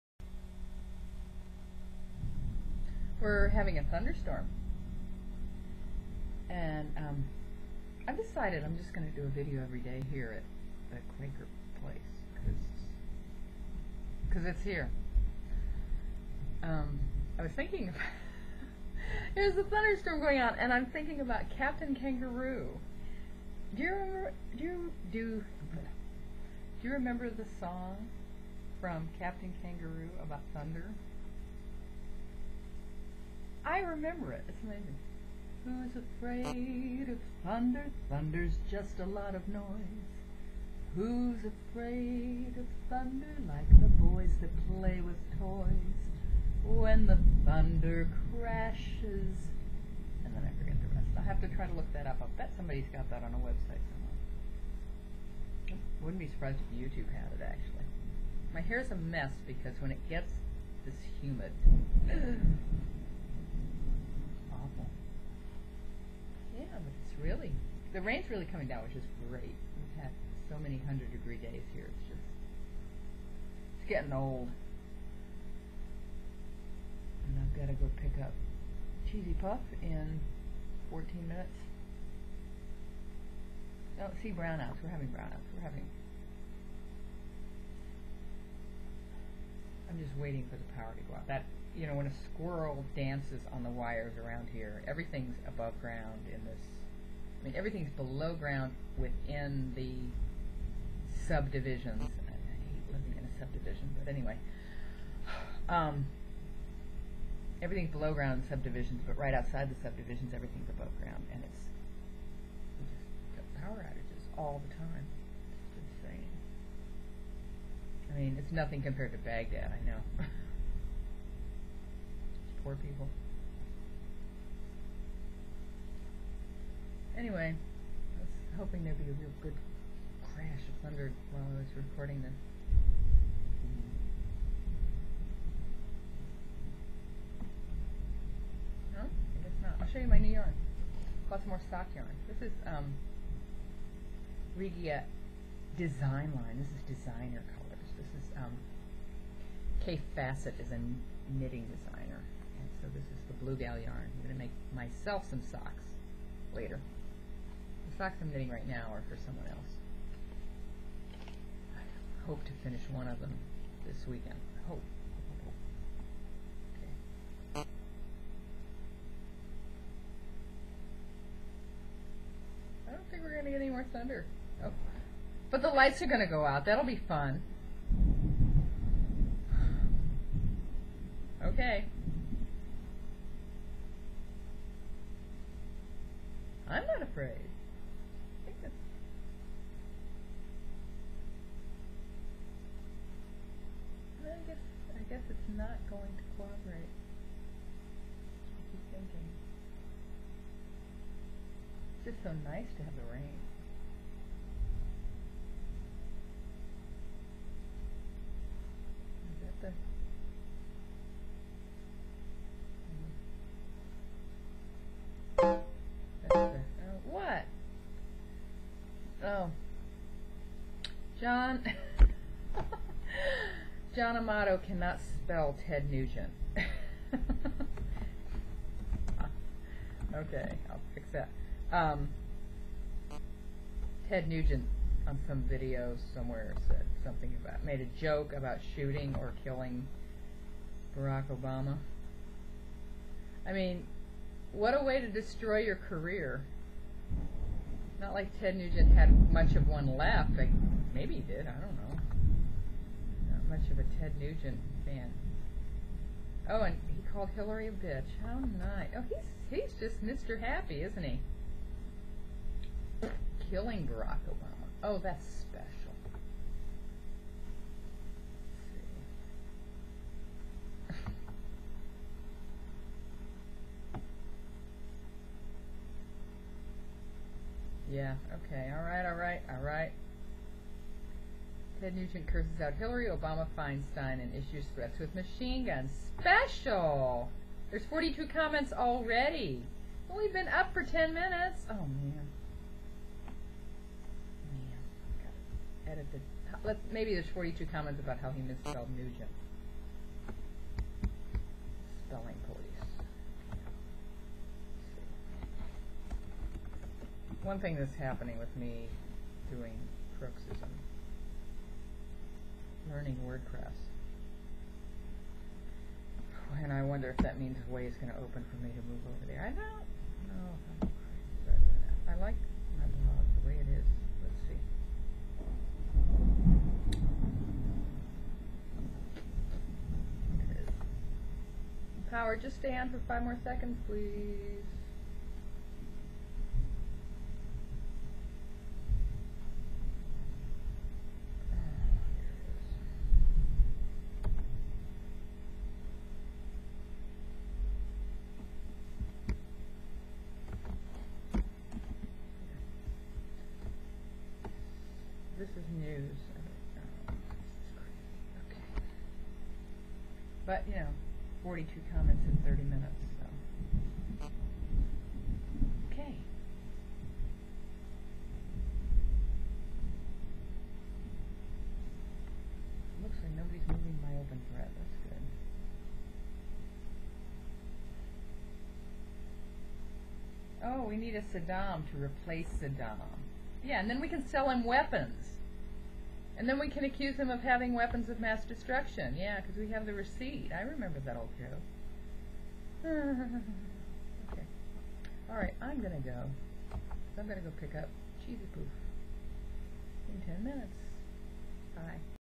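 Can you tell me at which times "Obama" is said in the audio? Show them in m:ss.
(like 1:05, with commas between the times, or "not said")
4:01, 4:24, 4:43.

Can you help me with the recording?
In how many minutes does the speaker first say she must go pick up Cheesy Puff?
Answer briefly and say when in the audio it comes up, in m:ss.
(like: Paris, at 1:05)
14, at 1:20.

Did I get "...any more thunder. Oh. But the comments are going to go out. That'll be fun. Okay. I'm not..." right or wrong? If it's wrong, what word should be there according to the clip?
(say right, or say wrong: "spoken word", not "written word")
wrong: "lights", not "comments".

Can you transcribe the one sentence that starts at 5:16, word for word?
And I wonder if that means the way is going to open for me to move over there.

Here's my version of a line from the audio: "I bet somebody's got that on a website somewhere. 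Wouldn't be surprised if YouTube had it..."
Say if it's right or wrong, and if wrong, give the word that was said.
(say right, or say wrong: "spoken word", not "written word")
right.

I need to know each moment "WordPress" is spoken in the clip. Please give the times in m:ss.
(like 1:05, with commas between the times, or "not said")
5:13.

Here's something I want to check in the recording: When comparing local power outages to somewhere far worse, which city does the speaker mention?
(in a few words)
Baghdad.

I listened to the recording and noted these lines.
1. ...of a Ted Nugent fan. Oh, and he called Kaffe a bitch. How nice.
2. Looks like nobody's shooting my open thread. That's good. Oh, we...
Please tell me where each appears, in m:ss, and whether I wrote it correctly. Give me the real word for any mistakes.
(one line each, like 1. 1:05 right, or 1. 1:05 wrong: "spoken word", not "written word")
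1. 4:13 wrong: "Hillary", not "Kaffe"
2. 6:13 wrong: "moving", not "shooting".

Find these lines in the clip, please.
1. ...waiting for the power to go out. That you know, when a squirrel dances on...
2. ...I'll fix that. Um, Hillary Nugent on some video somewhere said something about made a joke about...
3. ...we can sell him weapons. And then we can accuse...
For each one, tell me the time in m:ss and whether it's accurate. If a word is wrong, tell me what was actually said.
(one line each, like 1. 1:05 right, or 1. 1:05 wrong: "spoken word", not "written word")
1. 1:30 right
2. 3:50 wrong: "Ted", not "Hillary"
3. 6:24 right.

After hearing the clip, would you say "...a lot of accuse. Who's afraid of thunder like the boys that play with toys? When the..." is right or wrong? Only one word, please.
wrong.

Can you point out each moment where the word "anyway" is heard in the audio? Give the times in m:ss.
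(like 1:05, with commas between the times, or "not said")
1:44, 2:07.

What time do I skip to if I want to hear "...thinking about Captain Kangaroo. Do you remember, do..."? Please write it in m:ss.
0:20.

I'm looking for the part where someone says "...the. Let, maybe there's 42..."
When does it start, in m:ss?
4:56.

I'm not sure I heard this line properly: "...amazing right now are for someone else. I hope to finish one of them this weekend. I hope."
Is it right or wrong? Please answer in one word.
wrong.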